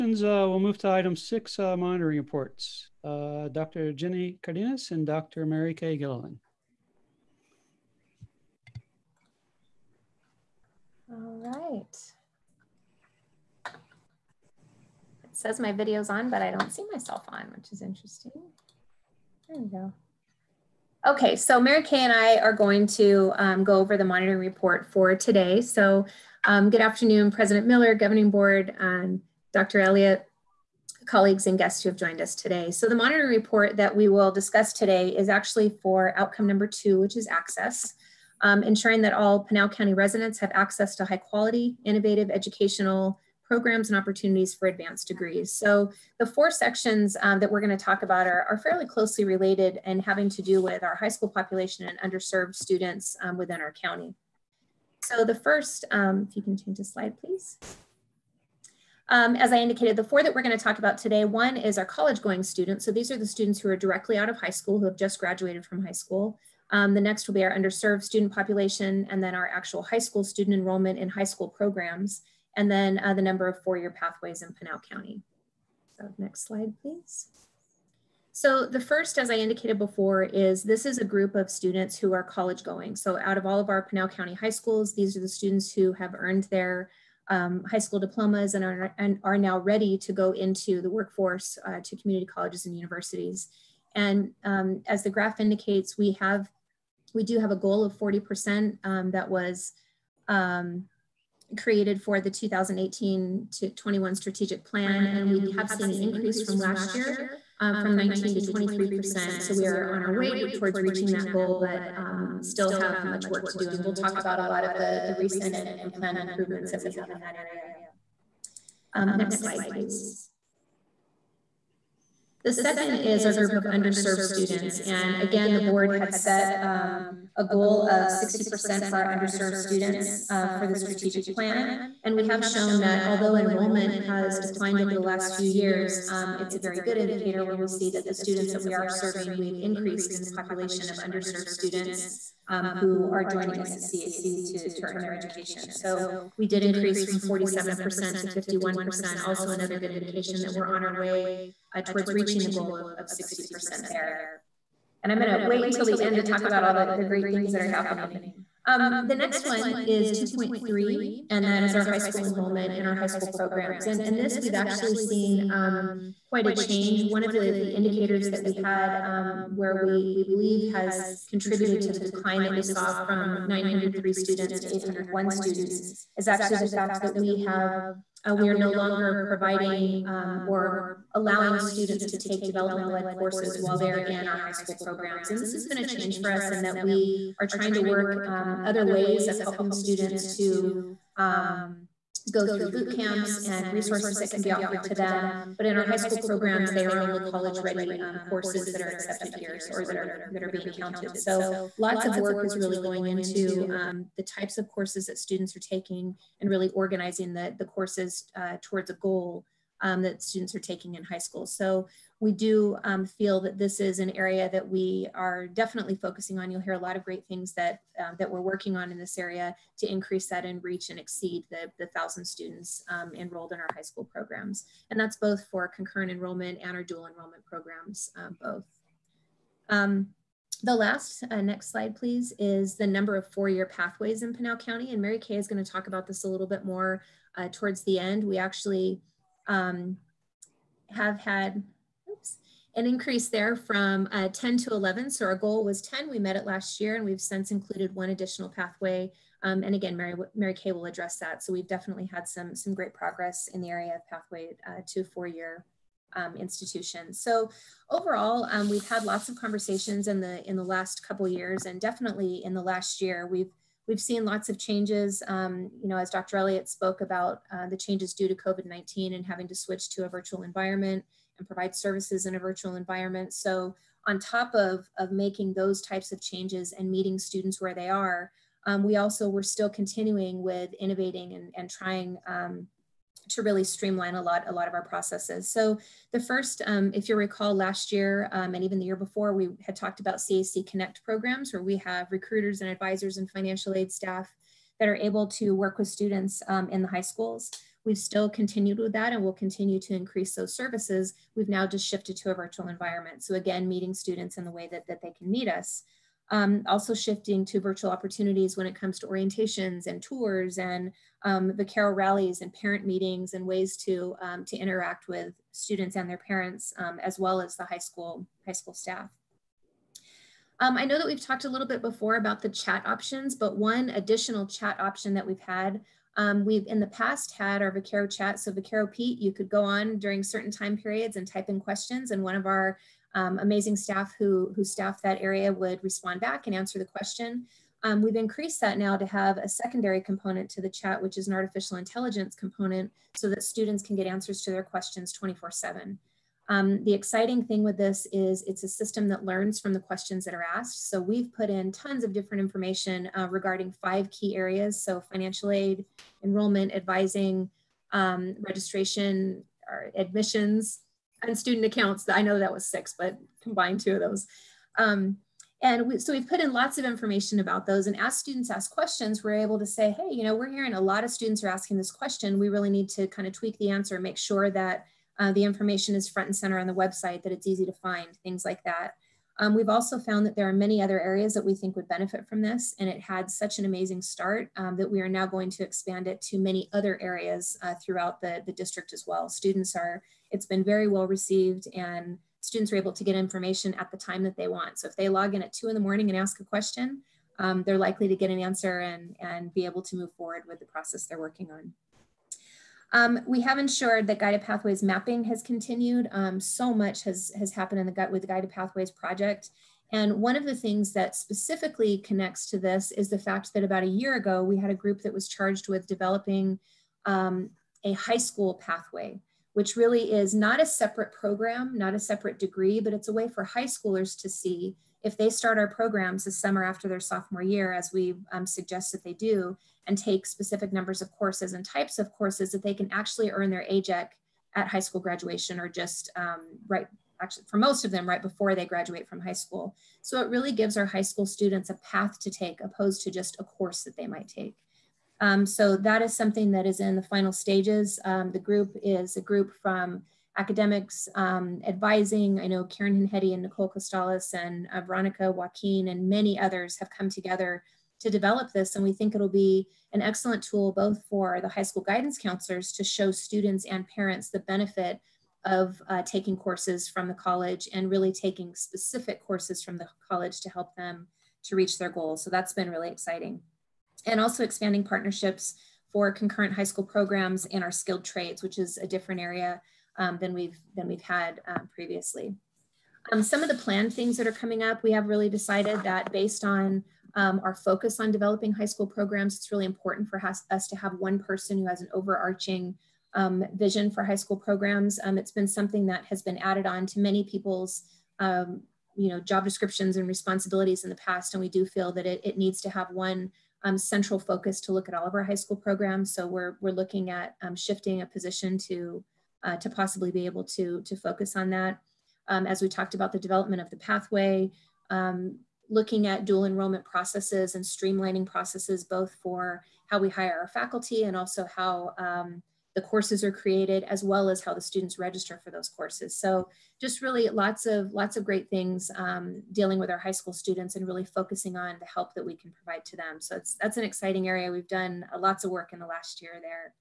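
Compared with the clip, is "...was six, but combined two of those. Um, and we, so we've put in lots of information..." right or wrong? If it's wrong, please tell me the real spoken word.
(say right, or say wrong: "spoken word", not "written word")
right.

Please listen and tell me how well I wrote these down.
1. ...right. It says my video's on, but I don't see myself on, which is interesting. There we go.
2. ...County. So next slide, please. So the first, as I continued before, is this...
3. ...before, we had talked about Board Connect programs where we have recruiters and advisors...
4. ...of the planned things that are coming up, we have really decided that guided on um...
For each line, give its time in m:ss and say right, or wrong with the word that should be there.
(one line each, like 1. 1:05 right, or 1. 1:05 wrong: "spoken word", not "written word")
1. 0:11 right
2. 1:14 wrong: "indicated", not "continued"
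3. 4:48 wrong: "CAC", not "Board"
4. 8:03 wrong: "based", not "guided".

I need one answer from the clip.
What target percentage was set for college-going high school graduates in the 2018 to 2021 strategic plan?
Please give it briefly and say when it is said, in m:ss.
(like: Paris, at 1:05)
40%, at 1:37.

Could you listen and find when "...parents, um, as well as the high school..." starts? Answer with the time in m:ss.
5:16.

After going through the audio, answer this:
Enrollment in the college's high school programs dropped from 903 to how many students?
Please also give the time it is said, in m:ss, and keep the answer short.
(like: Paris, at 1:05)
801, at 2:54.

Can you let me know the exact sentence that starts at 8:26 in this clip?
So we're, we're looking at um, shifting a position to, uh, to possibly be able to, to focus on that.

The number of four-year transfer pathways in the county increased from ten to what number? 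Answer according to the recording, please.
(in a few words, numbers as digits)
11.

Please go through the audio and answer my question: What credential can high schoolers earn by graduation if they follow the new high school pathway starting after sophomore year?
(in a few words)
AGEC.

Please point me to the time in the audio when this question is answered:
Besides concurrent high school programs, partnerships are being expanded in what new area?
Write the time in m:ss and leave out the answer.
7:57.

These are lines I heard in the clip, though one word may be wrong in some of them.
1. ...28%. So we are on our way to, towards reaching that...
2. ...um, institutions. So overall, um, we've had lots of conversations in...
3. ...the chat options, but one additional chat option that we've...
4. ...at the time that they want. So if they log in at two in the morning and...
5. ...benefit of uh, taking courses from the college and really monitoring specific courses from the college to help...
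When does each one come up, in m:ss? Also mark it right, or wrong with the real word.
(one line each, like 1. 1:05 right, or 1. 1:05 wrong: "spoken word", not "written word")
1. 1:48 wrong: "23", not "28"
2. 4:16 right
3. 5:22 right
4. 6:33 right
5. 7:44 wrong: "taking", not "monitoring".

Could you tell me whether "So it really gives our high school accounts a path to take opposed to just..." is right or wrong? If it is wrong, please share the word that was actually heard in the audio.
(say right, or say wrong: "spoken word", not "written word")
wrong: "students", not "accounts".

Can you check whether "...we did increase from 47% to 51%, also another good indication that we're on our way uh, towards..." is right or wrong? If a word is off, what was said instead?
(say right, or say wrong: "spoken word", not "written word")
right.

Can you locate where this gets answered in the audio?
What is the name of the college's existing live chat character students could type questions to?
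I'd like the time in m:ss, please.
5:28.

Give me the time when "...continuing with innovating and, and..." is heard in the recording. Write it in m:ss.
4:39.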